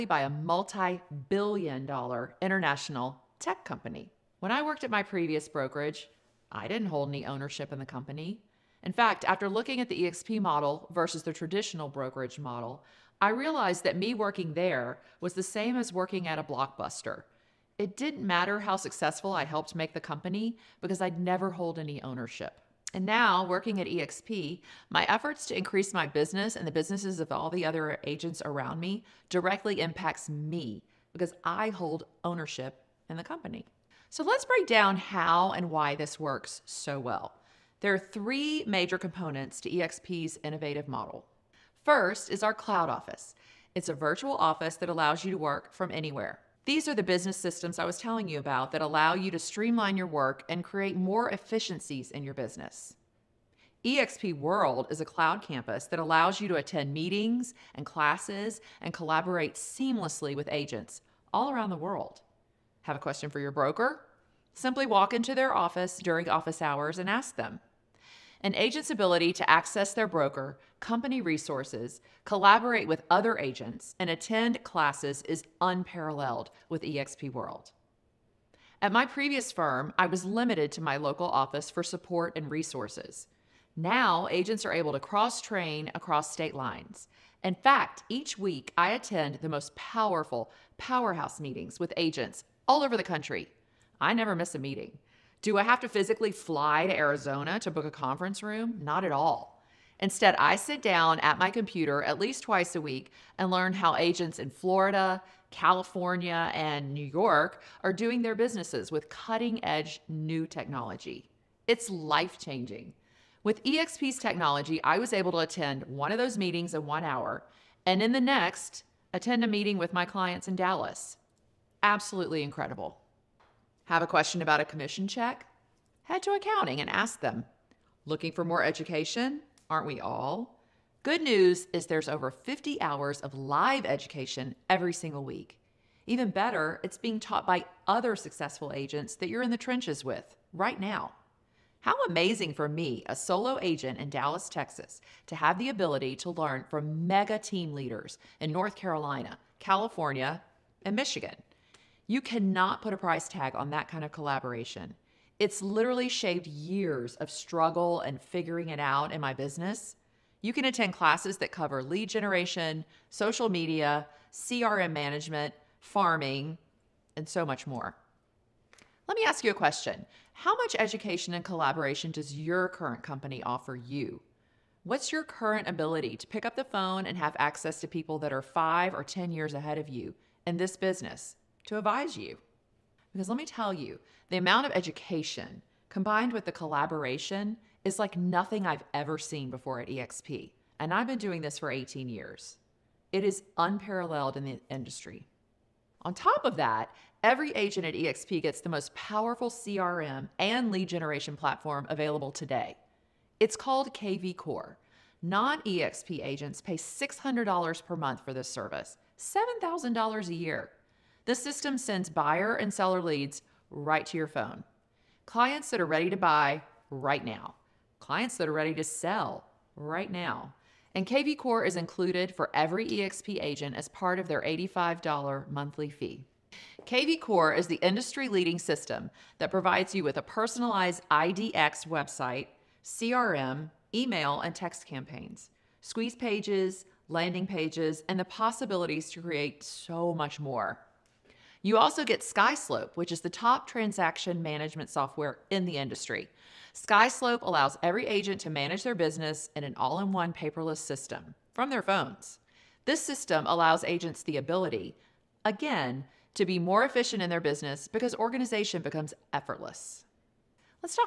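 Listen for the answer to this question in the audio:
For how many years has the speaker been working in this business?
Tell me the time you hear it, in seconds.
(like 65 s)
191 s.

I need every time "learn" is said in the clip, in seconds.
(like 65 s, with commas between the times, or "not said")
103 s, 146 s.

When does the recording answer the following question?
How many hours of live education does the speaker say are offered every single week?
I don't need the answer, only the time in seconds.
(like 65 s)
132 s.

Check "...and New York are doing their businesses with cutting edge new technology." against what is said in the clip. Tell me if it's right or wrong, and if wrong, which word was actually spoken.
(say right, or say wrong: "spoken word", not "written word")
right.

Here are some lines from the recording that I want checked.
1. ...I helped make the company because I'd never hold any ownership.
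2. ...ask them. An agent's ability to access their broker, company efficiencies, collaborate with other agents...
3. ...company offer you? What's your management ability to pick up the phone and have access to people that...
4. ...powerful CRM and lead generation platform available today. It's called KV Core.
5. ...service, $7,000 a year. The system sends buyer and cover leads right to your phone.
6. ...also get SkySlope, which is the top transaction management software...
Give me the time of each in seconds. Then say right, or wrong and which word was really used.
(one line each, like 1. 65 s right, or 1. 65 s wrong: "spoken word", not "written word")
1. 19 s right
2. 67 s wrong: "resources", not "efficiencies"
3. 173 s wrong: "current", not "management"
4. 198 s right
5. 208 s wrong: "seller", not "cover"
6. 241 s right.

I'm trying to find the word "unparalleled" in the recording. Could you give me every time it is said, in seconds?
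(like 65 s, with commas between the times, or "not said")
75 s, 193 s.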